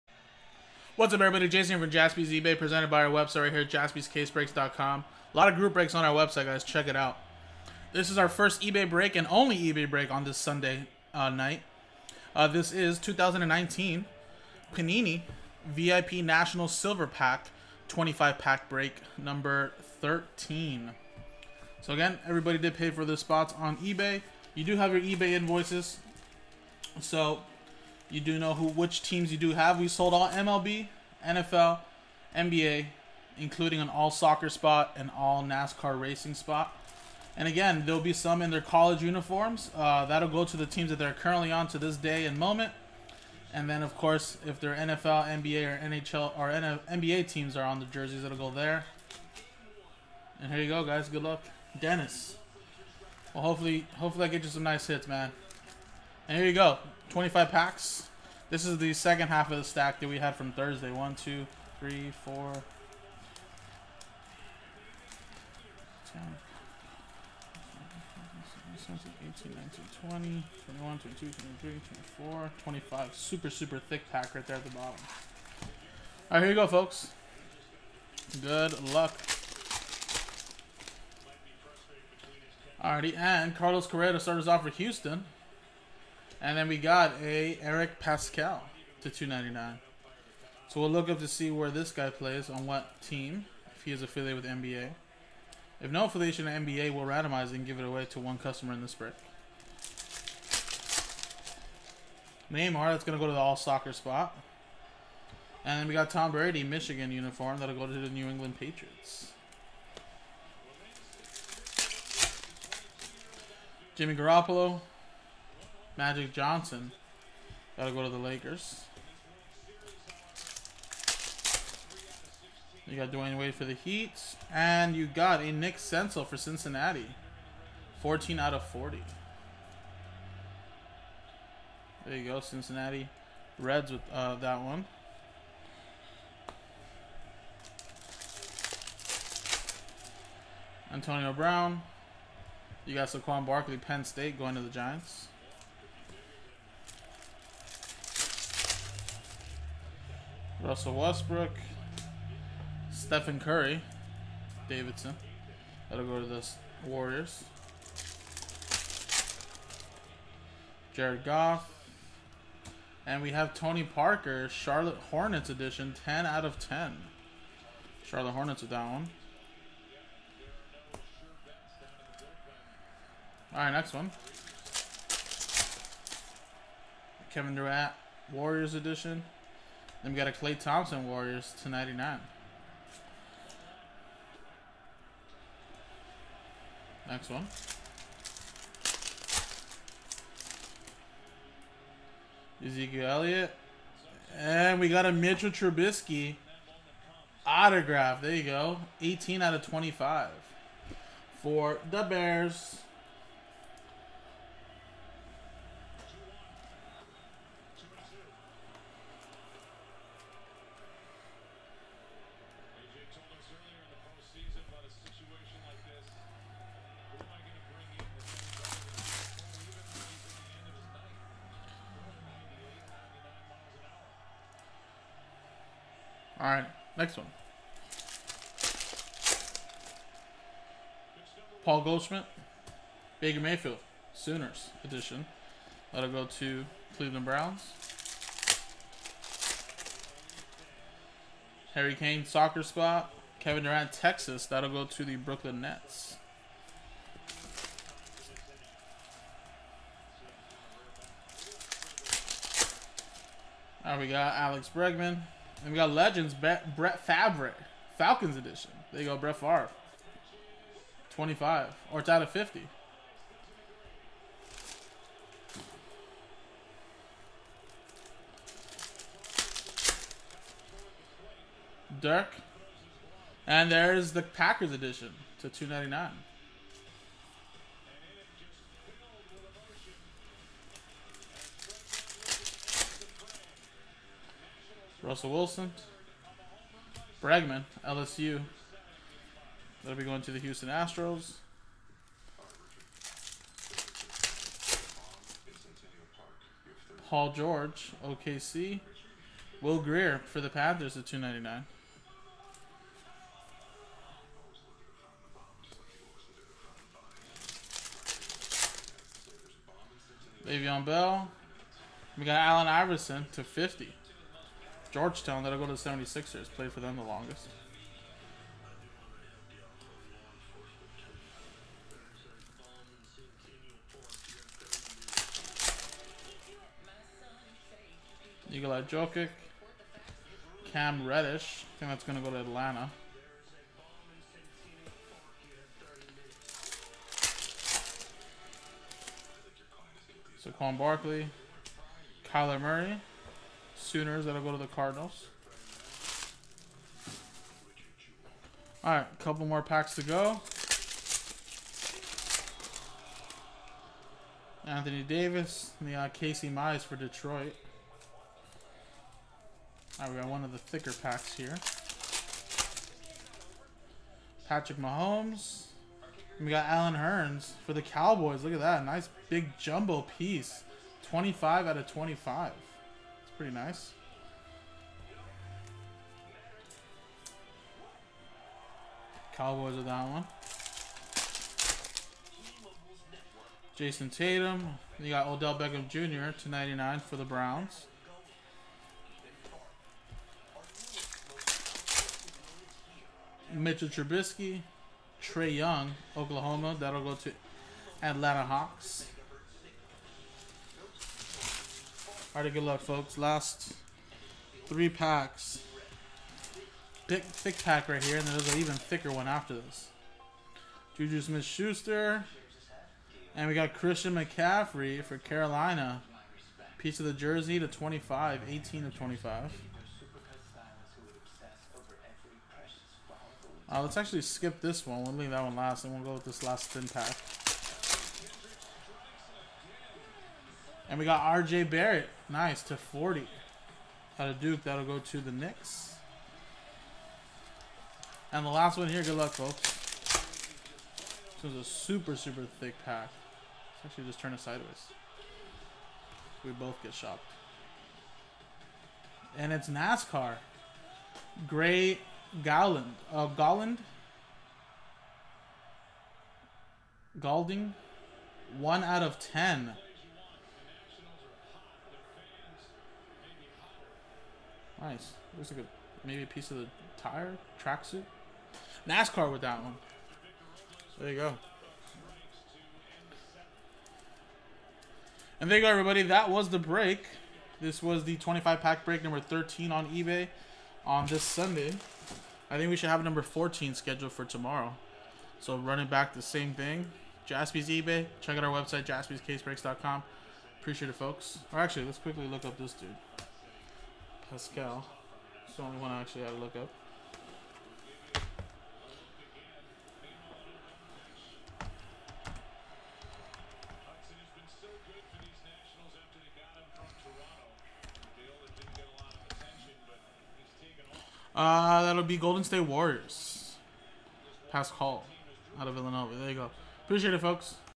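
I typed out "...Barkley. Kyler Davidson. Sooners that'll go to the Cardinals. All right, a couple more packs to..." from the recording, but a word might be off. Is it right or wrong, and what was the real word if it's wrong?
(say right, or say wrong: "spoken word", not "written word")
wrong: "Murray", not "Davidson".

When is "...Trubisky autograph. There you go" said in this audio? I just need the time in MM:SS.
03:15.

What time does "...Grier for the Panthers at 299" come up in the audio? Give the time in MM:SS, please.
04:59.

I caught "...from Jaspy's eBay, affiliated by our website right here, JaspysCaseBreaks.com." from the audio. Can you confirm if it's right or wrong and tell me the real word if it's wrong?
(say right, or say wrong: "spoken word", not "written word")
wrong: "presented", not "affiliated".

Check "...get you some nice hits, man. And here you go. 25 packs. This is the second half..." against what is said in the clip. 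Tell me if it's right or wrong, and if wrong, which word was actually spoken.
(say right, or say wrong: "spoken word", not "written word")
right.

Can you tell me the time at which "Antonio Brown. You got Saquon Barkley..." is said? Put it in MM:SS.
02:20.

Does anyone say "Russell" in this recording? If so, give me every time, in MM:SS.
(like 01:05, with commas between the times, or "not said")
02:30, 04:45.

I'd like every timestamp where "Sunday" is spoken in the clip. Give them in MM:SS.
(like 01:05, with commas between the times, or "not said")
00:10, 08:01.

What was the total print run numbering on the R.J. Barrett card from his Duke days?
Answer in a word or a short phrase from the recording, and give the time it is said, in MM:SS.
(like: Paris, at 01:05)
40, at 07:12.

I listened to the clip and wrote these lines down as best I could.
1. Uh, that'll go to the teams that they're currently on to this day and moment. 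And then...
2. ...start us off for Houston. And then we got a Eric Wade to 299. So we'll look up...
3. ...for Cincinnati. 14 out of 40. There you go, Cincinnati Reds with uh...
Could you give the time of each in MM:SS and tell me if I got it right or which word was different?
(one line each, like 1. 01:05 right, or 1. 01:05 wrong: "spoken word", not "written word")
1. 00:39 right
2. 01:24 wrong: "Paschall", not "Wade"
3. 02:06 right.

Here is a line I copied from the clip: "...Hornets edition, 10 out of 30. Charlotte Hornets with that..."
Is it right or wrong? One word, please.
wrong.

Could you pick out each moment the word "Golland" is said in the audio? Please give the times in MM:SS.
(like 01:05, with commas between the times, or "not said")
07:33.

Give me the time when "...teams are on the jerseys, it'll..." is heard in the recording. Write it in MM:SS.
00:47.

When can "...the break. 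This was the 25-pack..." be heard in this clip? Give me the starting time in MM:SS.
07:56.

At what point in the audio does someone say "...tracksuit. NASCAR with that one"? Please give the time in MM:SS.
07:47.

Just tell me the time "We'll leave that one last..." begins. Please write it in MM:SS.
07:05.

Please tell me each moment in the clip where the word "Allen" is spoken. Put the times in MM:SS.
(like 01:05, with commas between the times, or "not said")
05:12, 06:06.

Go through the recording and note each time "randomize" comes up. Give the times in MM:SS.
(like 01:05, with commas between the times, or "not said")
01:37.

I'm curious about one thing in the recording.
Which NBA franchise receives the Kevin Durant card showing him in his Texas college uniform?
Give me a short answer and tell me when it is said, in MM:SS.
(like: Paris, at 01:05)
Brooklyn Nets, at 04:05.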